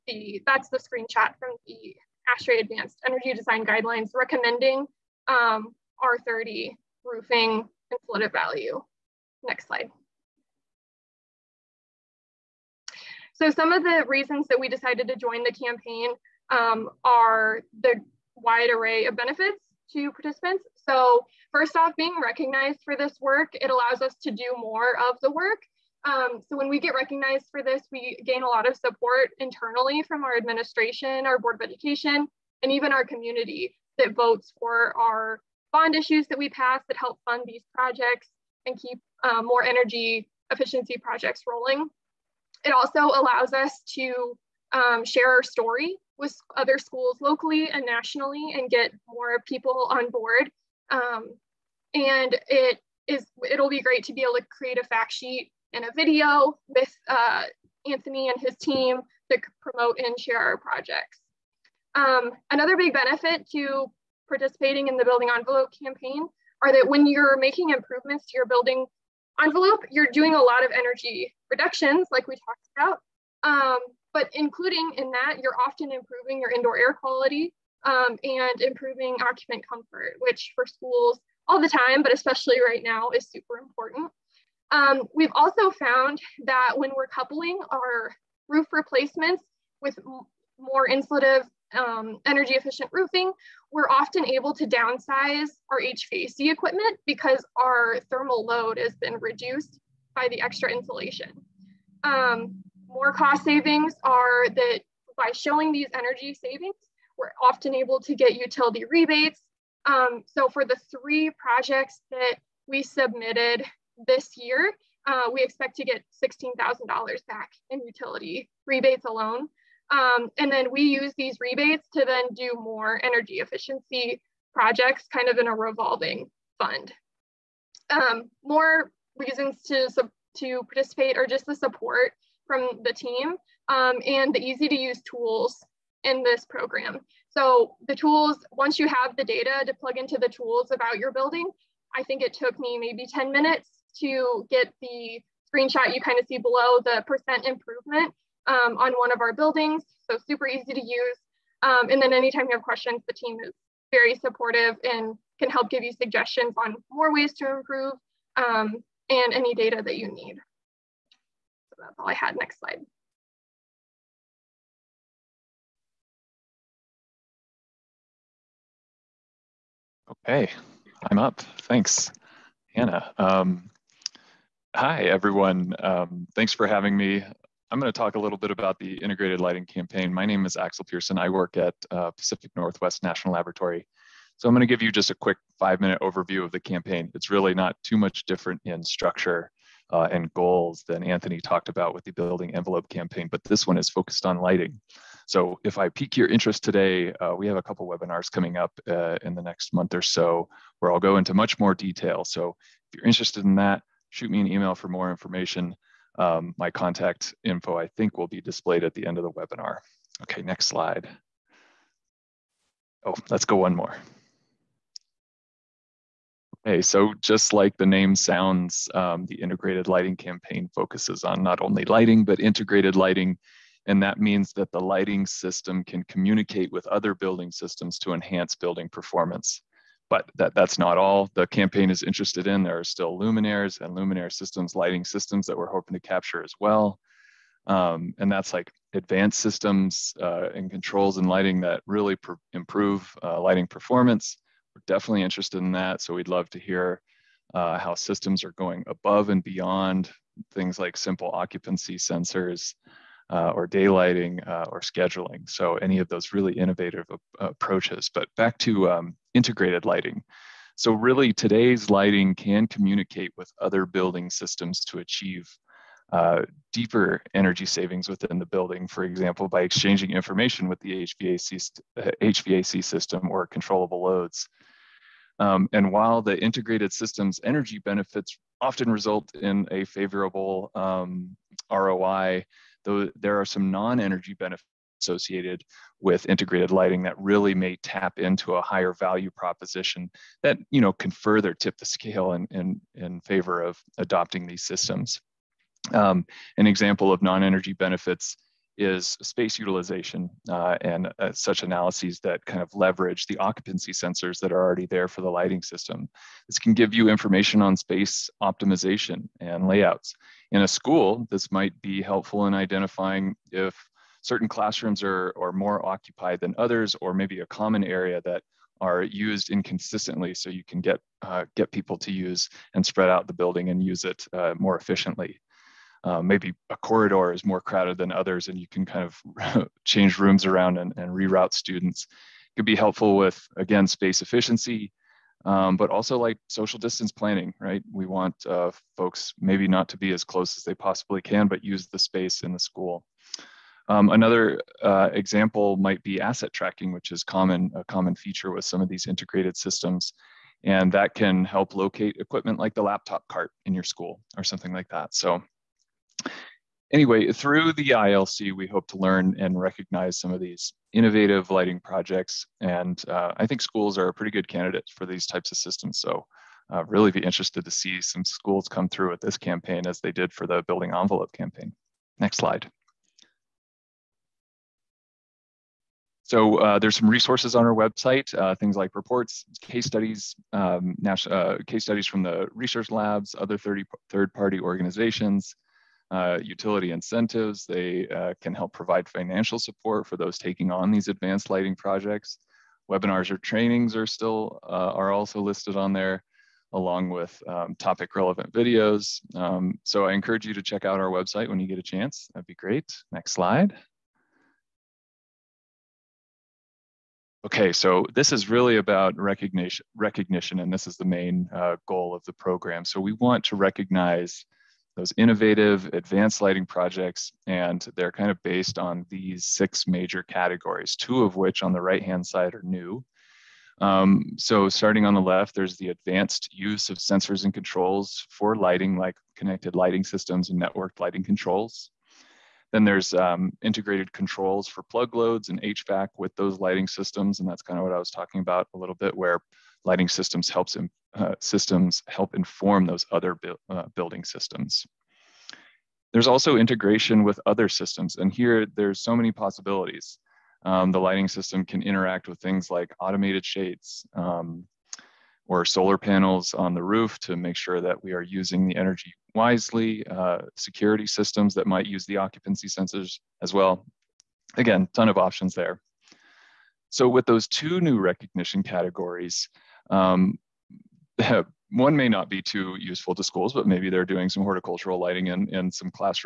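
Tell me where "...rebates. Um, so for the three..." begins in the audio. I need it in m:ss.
1:48.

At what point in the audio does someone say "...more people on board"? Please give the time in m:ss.
0:49.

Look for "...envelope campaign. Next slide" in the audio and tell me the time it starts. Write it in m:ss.
6:10.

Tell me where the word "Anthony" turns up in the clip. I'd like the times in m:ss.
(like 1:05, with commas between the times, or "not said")
0:57, 3:11.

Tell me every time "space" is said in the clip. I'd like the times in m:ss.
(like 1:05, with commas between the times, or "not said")
4:59, 5:07, 5:33, 5:41.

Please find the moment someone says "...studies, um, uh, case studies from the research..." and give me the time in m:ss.
6:19.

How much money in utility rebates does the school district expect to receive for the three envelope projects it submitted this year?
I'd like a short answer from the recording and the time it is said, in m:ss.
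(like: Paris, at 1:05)
$16,000, at 1:56.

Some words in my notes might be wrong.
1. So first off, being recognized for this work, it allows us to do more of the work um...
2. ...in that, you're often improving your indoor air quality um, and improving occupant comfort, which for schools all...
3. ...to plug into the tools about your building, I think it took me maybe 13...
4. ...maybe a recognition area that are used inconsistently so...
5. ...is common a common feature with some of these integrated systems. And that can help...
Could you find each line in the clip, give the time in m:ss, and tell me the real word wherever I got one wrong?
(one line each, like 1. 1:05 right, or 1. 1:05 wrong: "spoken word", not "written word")
1. 0:20 right
2. 1:14 right
3. 2:19 wrong: "10", not "13"
4. 5:17 wrong: "common", not "recognition"
5. 5:47 right.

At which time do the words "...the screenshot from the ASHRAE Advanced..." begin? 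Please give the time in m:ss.
0:00.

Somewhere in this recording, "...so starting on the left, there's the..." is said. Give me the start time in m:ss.
7:04.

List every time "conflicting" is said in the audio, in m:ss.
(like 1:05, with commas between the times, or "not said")
not said.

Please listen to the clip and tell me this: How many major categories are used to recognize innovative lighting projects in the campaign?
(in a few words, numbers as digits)
6.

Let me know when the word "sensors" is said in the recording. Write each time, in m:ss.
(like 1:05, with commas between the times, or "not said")
4:11, 5:03, 7:06, 7:42.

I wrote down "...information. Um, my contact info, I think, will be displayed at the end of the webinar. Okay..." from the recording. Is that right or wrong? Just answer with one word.
right.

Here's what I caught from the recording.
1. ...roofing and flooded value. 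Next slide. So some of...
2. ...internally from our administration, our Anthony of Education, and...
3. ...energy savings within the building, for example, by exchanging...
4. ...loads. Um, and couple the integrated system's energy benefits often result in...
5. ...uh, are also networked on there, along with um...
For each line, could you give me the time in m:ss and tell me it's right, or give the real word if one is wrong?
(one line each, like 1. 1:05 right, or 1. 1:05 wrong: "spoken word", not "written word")
1. 0:07 right
2. 0:29 wrong: "Board", not "Anthony"
3. 4:27 right
4. 4:34 wrong: "while", not "couple"
5. 6:34 wrong: "listed", not "networked".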